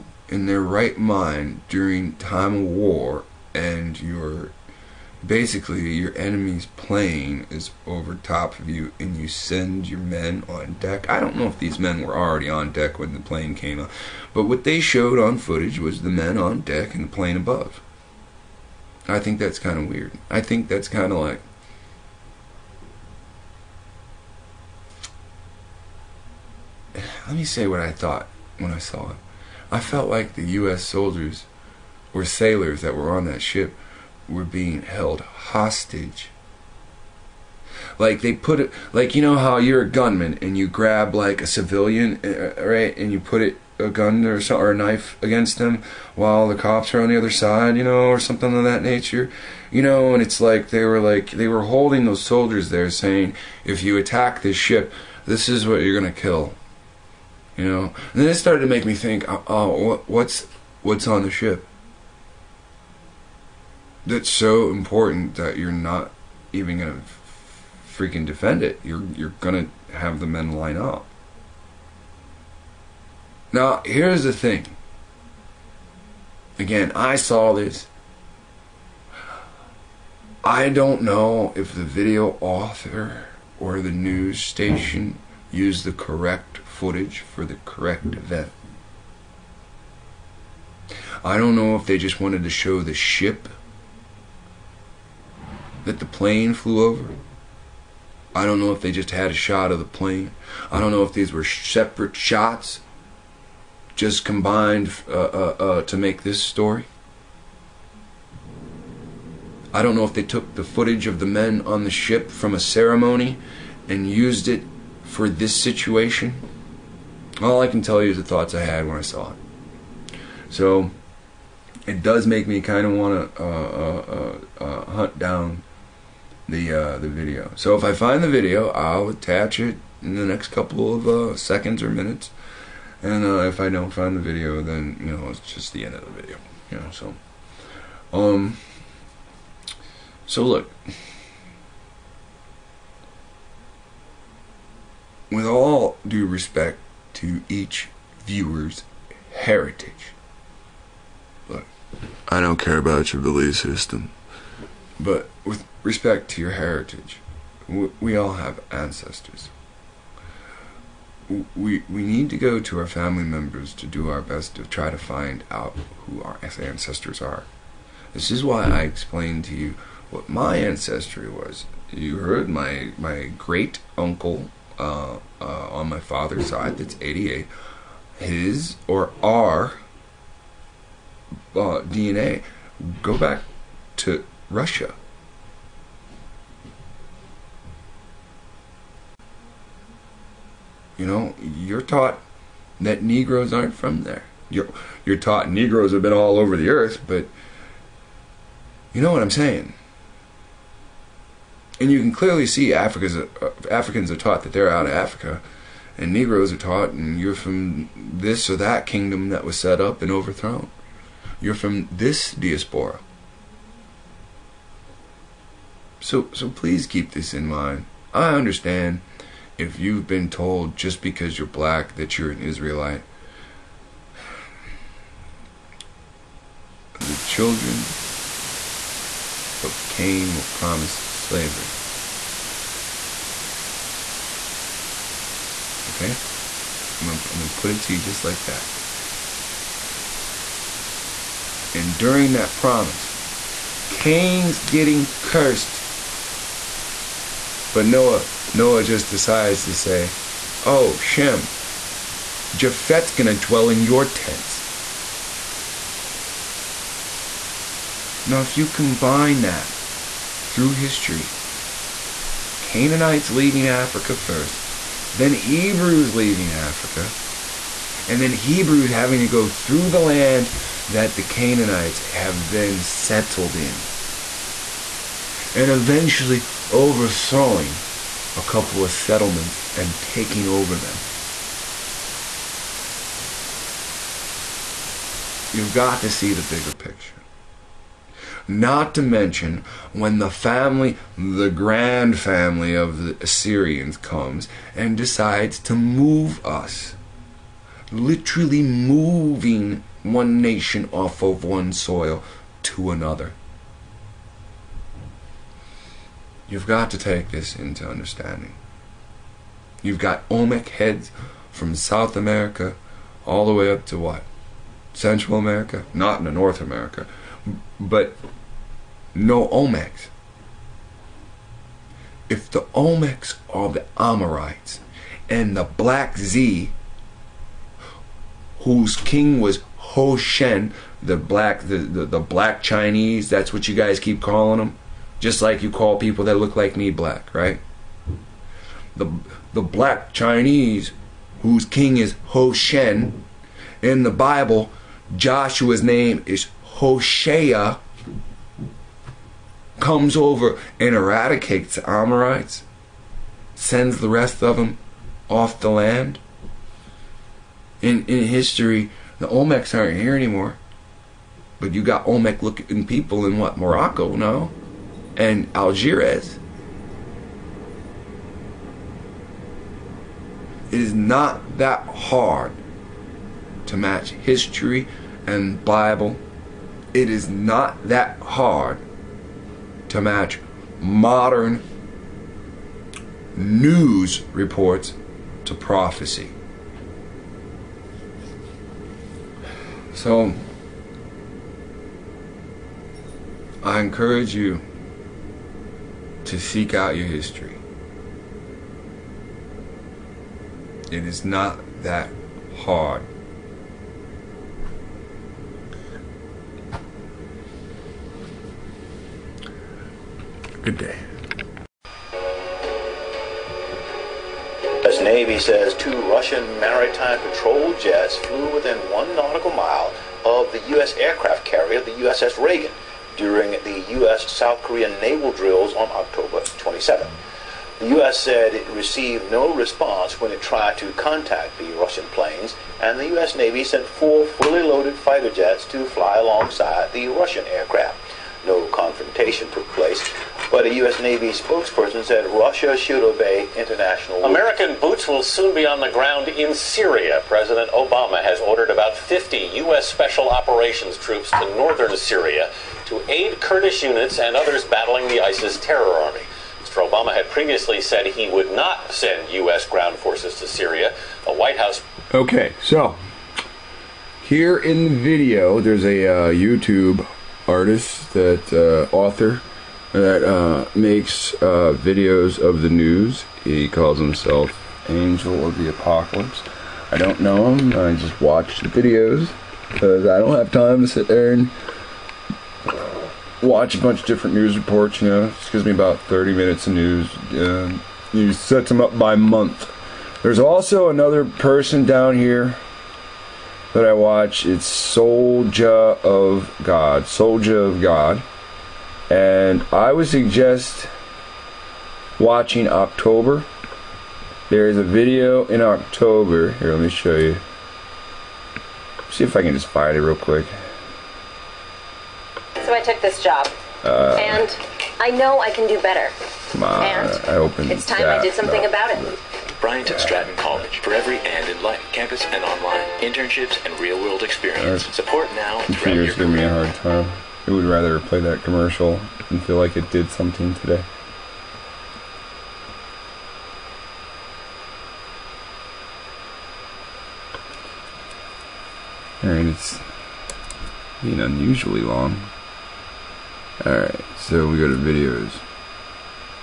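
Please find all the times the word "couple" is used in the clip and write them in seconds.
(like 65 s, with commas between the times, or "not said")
130 s, 278 s.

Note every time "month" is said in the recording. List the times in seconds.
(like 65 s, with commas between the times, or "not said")
489 s.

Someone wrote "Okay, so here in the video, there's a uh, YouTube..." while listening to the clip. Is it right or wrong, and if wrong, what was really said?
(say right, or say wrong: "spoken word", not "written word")
right.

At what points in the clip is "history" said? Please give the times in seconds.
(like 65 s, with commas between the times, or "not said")
260 s, 358 s, 374 s, 397 s.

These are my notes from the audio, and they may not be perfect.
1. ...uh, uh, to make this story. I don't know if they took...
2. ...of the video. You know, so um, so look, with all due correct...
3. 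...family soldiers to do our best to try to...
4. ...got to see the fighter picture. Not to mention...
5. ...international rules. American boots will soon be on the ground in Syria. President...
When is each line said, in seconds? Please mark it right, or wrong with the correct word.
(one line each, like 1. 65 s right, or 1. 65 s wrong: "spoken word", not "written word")
1. 105 s right
2. 135 s wrong: "respect", not "correct"
3. 162 s wrong: "members", not "soldiers"
4. 285 s wrong: "bigger", not "fighter"
5. 443 s right.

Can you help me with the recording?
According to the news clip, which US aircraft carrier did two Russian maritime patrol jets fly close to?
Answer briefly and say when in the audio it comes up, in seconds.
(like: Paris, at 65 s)
USS Reagan, at 421 s.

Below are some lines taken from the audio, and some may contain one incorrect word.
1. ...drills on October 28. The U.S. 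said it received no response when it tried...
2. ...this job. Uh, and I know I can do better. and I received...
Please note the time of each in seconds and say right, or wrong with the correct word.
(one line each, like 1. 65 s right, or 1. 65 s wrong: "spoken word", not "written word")
1. 425 s wrong: "27", not "28"
2. 512 s wrong: "opened", not "received".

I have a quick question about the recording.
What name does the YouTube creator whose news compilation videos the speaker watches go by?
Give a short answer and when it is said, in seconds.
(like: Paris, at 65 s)
Angel of the Apocalypse, at 474 s.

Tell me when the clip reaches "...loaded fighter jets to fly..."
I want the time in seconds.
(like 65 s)
434 s.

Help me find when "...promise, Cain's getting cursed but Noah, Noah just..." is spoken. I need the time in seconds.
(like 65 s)
242 s.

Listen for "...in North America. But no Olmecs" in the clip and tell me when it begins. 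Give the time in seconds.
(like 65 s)
316 s.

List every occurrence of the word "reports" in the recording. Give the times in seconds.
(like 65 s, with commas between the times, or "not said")
384 s, 484 s.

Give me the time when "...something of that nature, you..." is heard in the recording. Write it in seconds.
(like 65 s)
48 s.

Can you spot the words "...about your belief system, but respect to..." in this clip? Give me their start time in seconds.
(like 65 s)
152 s.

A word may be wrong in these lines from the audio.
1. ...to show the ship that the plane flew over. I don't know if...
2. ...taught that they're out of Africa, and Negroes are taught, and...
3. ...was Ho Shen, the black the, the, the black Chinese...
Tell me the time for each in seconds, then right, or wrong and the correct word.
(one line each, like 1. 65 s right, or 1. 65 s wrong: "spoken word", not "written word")
1. 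92 s right
2. 204 s right
3. 329 s right.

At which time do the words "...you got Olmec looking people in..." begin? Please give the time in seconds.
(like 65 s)
361 s.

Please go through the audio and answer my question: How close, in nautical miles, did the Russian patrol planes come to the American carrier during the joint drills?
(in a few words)
1.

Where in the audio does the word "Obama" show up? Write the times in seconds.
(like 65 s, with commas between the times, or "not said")
447 s, 456 s.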